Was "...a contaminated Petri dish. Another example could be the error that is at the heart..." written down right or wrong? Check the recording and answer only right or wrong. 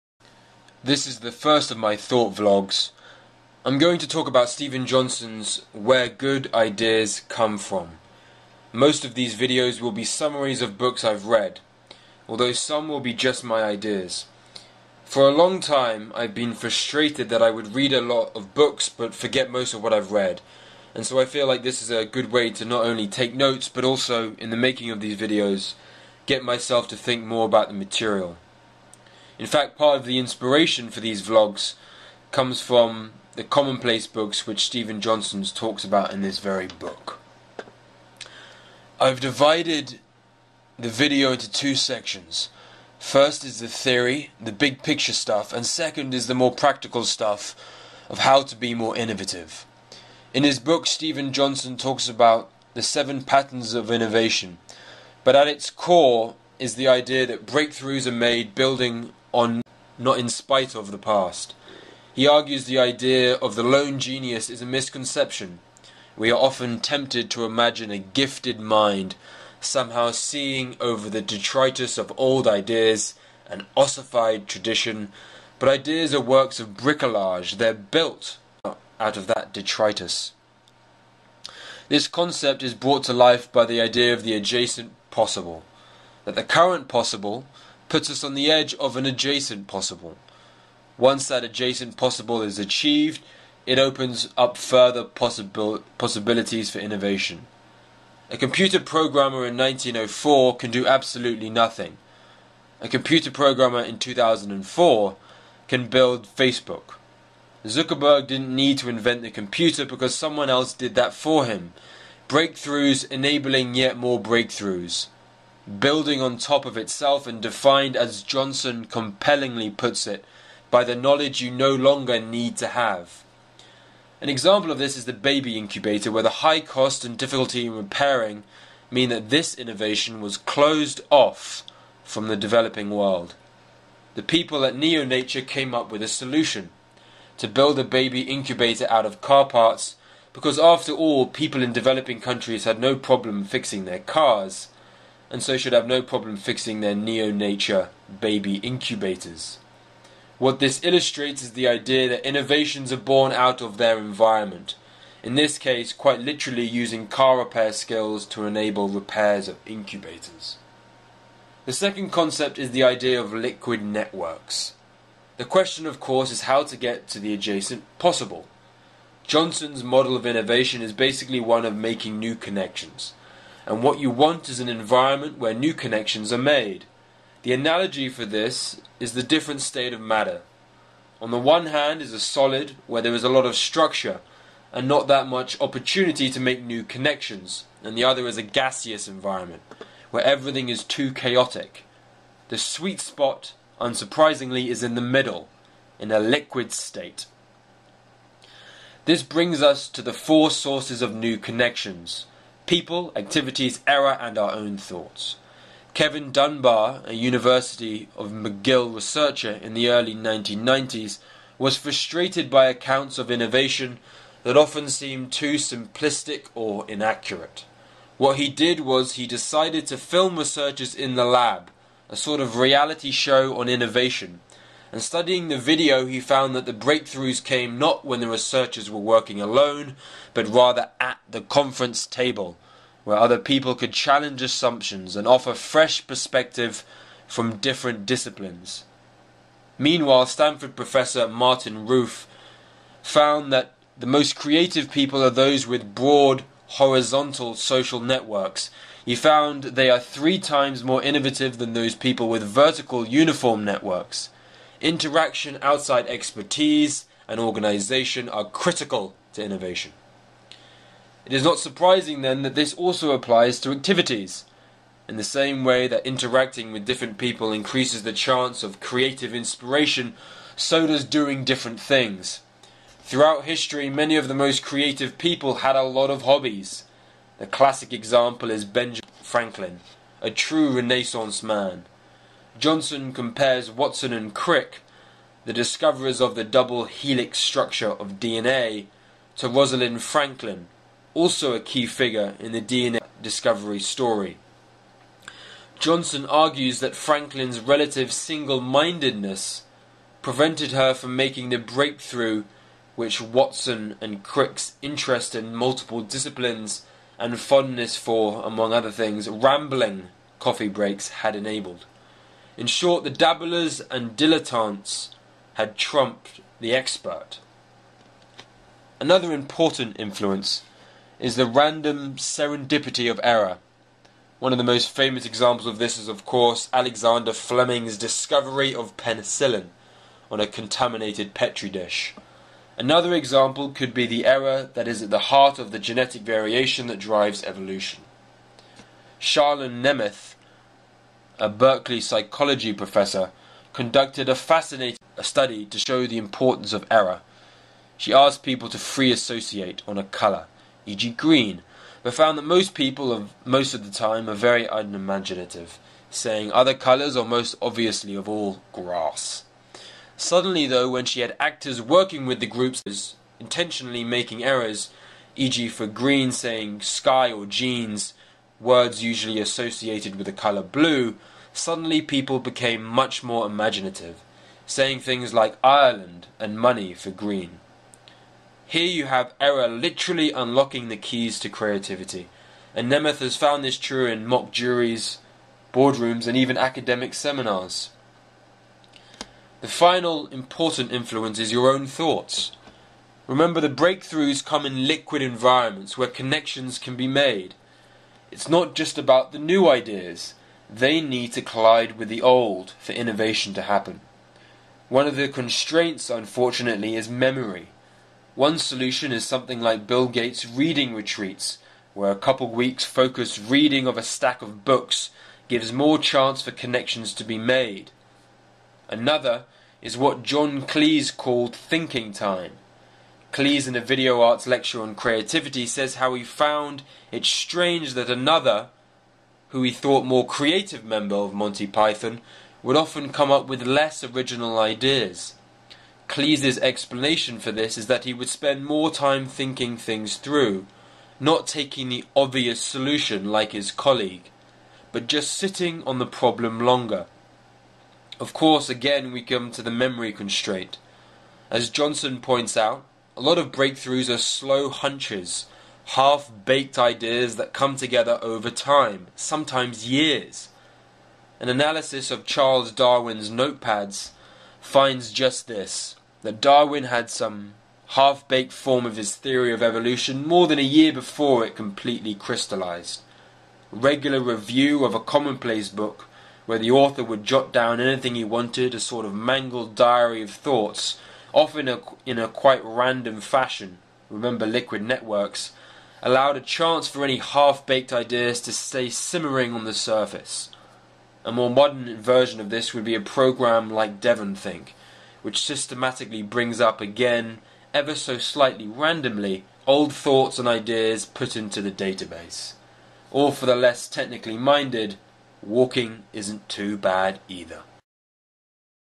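right.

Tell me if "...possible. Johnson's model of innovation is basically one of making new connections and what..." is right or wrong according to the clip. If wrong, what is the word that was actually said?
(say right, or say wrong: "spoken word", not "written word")
right.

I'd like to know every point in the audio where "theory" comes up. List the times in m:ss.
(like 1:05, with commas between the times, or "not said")
0:43, 7:49.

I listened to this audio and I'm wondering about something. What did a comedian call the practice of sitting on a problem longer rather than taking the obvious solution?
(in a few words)
thinking time.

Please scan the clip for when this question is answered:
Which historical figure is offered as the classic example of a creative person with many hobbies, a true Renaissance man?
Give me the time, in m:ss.
4:38.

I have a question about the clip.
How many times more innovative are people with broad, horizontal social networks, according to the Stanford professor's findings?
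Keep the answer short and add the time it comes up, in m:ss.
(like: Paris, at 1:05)
3, at 4:09.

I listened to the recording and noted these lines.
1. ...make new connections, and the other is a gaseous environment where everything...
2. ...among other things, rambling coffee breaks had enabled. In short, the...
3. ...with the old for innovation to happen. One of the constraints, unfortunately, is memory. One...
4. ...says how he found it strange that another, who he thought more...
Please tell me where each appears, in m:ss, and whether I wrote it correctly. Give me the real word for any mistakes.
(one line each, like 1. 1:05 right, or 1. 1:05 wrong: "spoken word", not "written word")
1. 3:06 right
2. 5:08 right
3. 6:41 right
4. 7:05 right.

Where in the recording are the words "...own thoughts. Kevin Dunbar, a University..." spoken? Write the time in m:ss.
3:24.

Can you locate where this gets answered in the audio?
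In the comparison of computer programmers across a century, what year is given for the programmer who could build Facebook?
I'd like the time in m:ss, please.
1:43.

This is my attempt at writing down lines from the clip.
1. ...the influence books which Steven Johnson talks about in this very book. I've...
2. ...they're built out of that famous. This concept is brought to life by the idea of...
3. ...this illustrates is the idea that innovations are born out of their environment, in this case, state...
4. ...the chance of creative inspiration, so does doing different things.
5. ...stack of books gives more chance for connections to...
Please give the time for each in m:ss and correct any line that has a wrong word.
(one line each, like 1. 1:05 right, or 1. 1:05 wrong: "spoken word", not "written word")
1. 0:33 wrong: "commonplace", not "influence"
2. 1:17 wrong: "detritus", not "famous"
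3. 2:30 wrong: "quite", not "state"
4. 4:28 right
5. 6:54 right.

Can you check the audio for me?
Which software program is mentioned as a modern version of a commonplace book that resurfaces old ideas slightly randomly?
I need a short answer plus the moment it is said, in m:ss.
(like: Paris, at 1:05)
DEVONthink, at 8:14.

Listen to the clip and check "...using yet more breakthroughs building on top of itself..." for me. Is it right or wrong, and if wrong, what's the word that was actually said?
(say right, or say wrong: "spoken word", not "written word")
wrong: "enabling", not "using".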